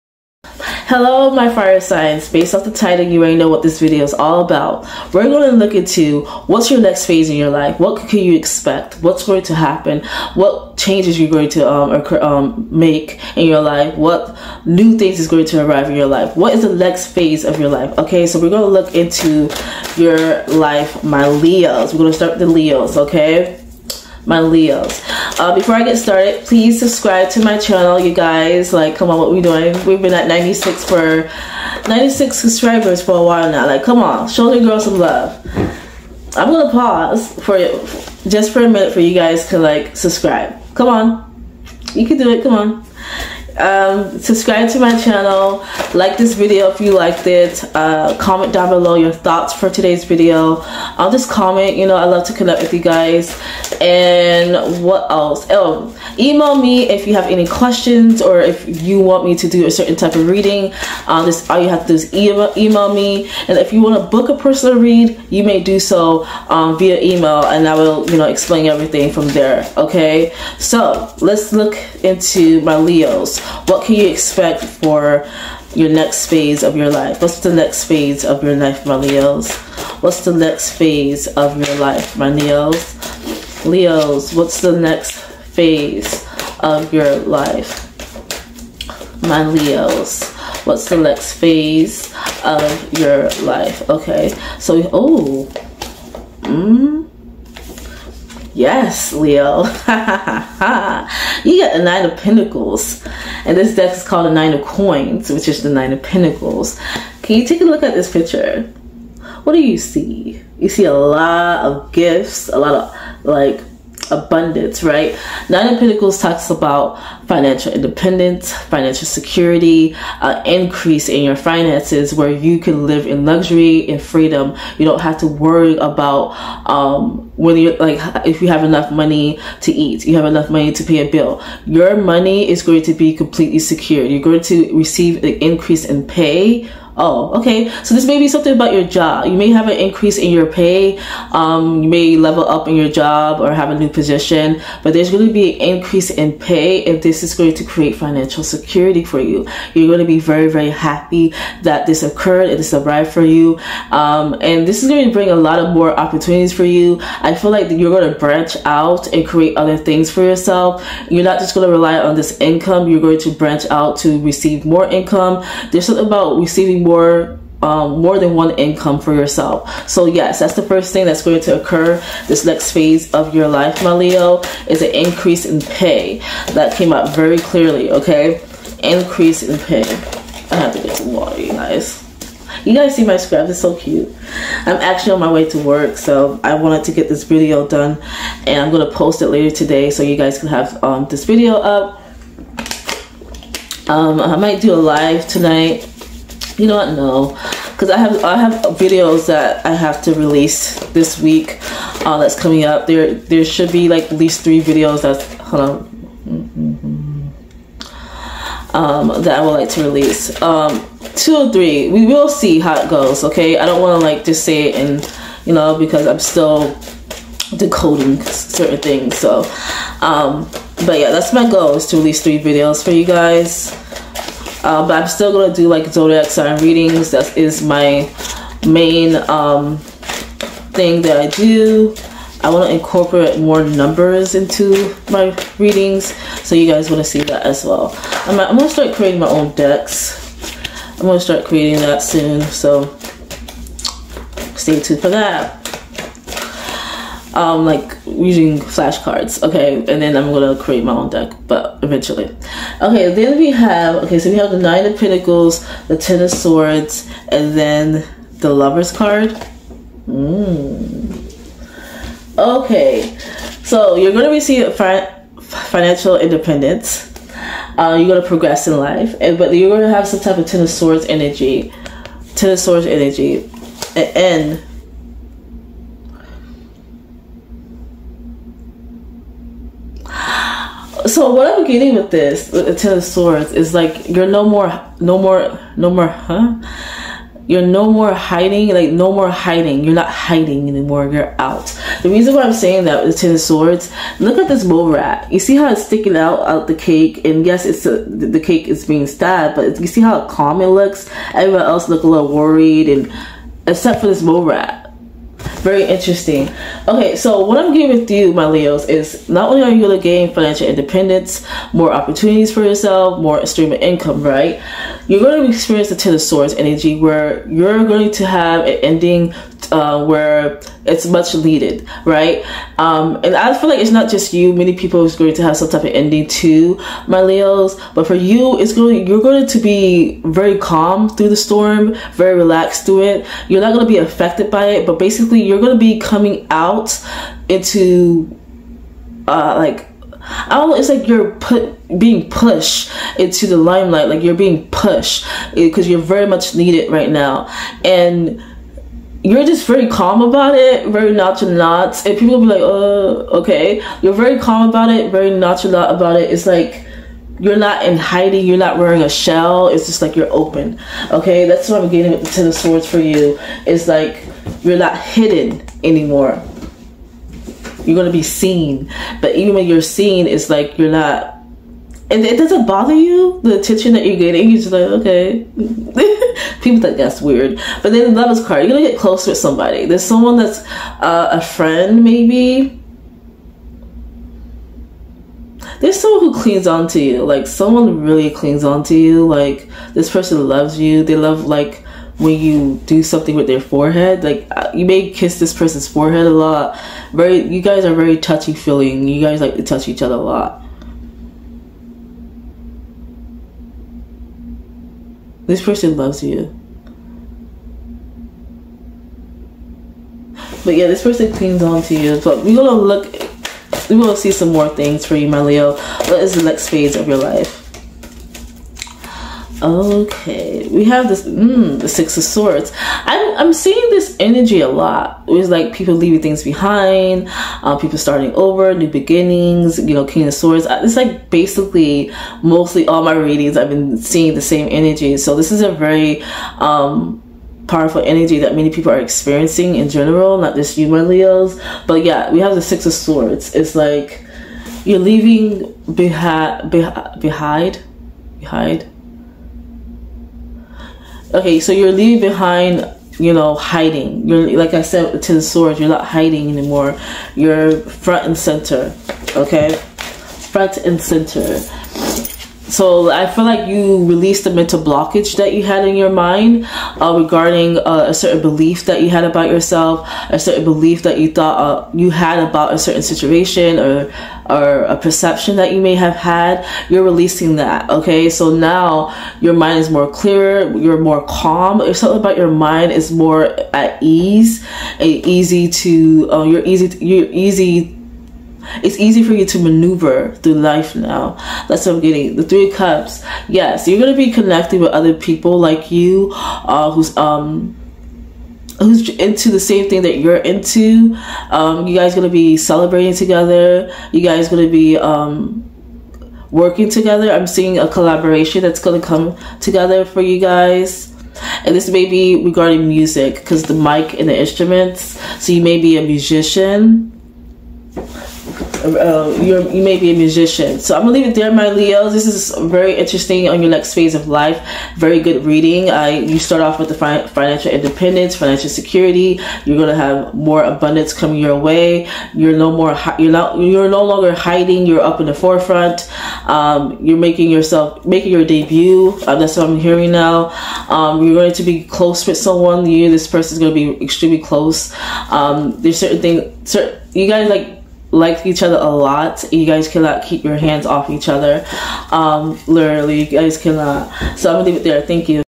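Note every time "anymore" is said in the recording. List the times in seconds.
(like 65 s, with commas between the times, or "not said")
290 s, 365 s, 456 s.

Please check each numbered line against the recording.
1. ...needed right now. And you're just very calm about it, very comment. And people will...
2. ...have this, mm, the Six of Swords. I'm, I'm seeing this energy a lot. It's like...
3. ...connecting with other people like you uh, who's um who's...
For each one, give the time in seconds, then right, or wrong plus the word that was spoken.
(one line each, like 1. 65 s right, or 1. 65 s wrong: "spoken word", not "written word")
1. 346 s wrong: "nonchalant", not "comment"
2. 420 s right
3. 494 s right.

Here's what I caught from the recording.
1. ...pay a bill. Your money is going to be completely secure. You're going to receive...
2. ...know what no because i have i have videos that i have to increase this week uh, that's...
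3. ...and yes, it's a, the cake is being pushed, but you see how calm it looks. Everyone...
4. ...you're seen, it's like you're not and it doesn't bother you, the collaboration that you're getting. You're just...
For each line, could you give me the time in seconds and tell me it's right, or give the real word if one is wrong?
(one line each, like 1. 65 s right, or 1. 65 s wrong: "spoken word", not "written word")
1. 130 s right
2. 196 s wrong: "release", not "increase"
3. 297 s wrong: "stabbed", not "pushed"
4. 369 s wrong: "attention", not "collaboration".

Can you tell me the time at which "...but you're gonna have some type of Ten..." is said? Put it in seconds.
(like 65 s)
269 s.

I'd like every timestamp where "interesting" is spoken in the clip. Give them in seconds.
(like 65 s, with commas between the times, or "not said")
305 s, 522 s.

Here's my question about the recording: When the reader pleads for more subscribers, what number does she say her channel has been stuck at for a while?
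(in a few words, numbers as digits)
96.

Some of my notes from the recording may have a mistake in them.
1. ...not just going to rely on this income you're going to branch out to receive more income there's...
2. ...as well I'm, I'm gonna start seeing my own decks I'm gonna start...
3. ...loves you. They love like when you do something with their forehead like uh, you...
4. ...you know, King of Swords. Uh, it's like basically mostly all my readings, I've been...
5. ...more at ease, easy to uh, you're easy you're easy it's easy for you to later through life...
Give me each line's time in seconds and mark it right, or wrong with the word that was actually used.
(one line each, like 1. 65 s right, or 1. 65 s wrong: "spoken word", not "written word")
1. 161 s right
2. 237 s wrong: "creating", not "seeing"
3. 390 s right
4. 429 s right
5. 483 s wrong: "maneuver", not "later".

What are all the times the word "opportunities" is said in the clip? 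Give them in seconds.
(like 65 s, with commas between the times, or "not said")
155 s, 311 s.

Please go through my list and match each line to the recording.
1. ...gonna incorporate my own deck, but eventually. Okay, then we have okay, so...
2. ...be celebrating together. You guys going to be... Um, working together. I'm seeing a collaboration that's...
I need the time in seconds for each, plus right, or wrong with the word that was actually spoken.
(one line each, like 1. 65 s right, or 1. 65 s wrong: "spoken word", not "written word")
1. 250 s wrong: "create", not "incorporate"
2. 502 s right.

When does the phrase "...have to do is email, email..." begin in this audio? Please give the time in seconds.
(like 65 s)
61 s.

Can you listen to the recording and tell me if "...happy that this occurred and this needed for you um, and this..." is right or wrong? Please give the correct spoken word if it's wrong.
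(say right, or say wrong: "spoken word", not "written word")
wrong: "arrived", not "needed".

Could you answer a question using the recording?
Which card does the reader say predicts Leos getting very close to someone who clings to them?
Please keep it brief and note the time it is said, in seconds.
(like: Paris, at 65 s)
Lovers card, at 378 s.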